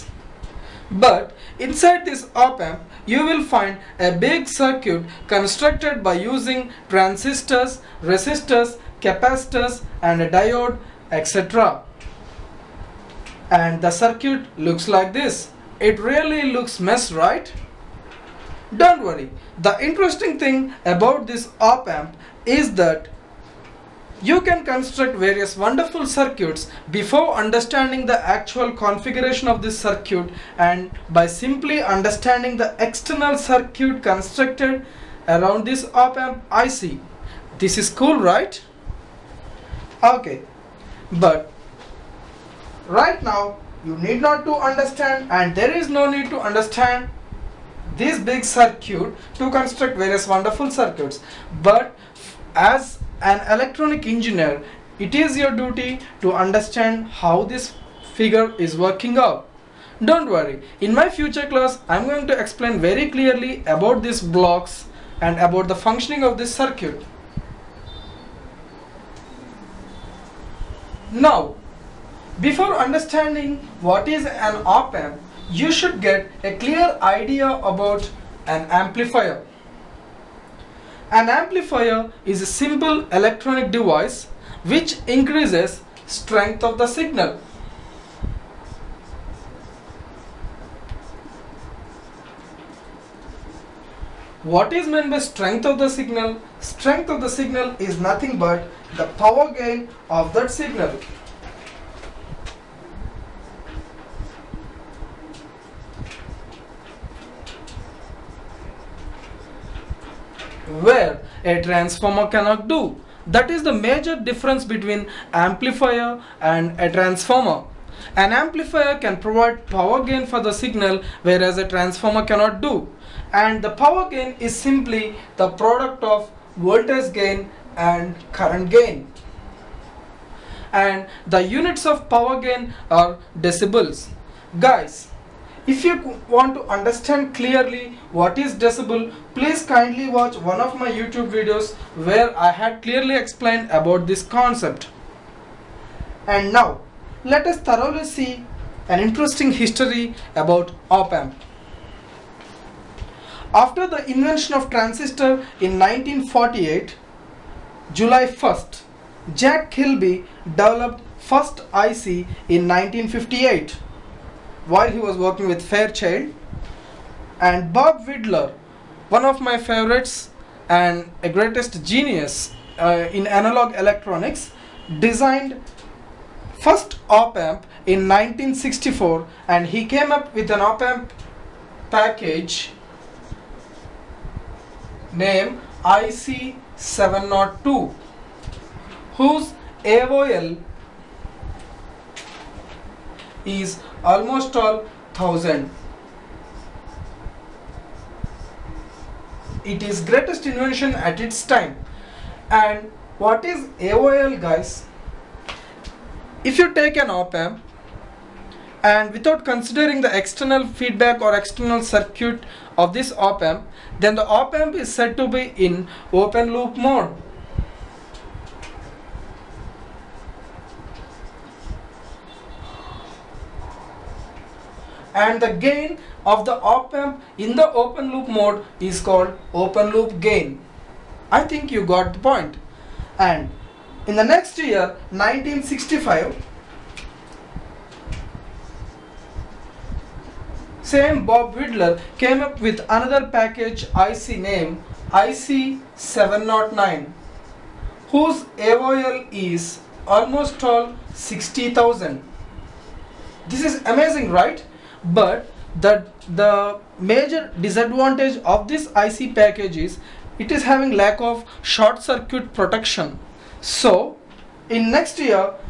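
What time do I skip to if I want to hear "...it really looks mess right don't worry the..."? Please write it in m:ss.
0:15.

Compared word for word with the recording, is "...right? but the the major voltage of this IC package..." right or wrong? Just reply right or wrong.
wrong.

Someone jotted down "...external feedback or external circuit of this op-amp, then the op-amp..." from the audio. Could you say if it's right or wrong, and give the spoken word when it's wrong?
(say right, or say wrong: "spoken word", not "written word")
right.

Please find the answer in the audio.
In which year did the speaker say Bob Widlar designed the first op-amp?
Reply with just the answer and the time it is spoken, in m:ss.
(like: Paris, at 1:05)
1964, at 2:58.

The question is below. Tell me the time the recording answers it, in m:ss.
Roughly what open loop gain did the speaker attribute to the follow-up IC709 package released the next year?
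4:11.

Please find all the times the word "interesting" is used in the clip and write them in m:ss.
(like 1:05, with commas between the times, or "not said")
0:19, 2:29.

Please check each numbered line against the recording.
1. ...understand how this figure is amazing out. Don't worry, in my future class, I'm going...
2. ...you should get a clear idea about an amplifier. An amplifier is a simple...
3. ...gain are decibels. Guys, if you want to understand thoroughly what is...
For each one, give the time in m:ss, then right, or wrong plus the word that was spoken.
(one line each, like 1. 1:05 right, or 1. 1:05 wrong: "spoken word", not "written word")
1. 0:56 wrong: "working", not "amazing"
2. 1:15 right
3. 2:12 wrong: "clearly", not "thoroughly".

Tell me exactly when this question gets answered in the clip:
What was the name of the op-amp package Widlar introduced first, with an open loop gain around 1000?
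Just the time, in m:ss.
3:05.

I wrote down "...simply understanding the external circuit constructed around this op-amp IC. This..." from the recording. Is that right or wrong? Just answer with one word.
right.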